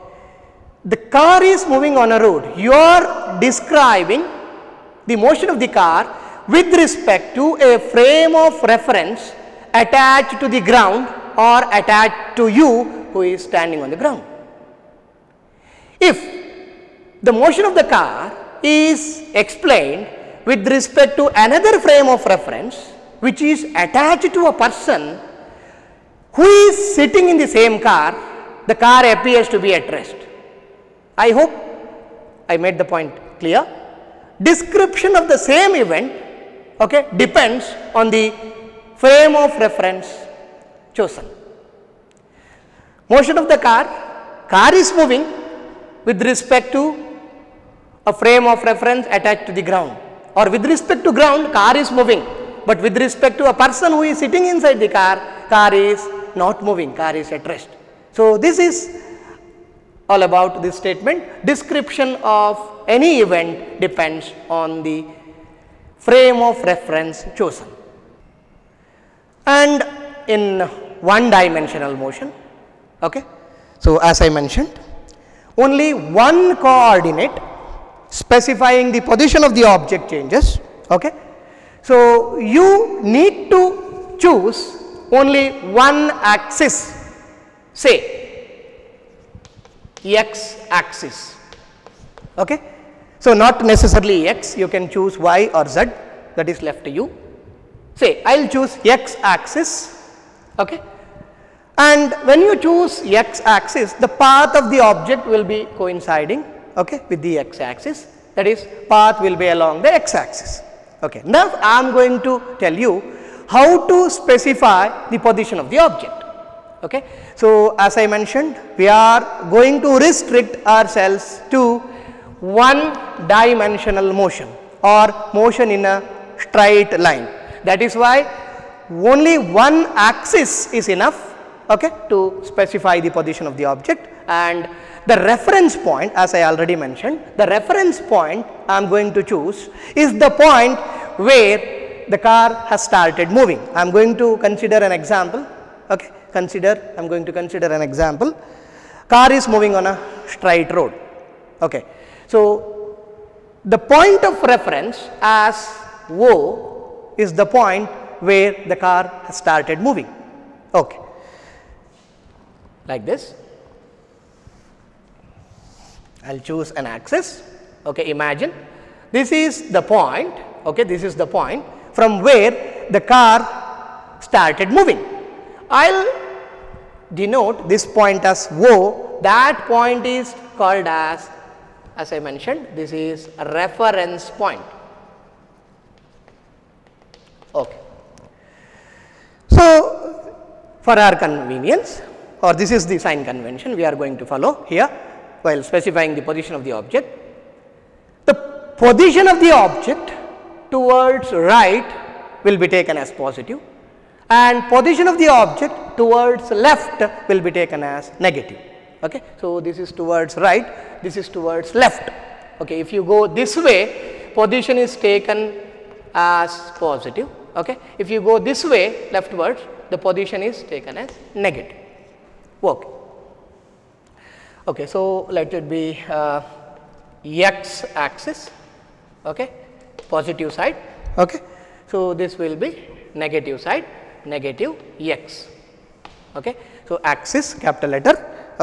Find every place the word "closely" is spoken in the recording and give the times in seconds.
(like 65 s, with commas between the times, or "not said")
not said.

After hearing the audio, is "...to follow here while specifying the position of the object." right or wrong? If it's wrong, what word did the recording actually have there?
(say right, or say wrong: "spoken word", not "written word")
right.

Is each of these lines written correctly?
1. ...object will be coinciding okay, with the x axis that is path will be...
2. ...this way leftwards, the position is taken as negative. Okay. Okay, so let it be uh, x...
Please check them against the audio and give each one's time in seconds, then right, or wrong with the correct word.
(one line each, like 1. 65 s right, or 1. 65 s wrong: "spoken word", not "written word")
1. 104 s right
2. 218 s right.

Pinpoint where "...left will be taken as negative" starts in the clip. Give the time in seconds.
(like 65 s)
206 s.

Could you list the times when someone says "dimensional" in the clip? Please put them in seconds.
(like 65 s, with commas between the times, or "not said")
71 s, 123 s.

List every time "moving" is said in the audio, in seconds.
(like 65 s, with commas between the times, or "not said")
1 s, 44 s, 51 s, 56 s, 143 s, 149 s, 159 s, 174 s.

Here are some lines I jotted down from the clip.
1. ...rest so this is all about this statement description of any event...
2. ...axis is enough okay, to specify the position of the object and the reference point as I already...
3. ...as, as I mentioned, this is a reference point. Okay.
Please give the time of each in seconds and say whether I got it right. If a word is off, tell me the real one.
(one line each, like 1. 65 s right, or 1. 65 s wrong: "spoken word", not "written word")
1. 57 s right
2. 129 s right
3. 180 s right.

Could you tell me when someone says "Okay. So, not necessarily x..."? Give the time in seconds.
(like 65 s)
92 s.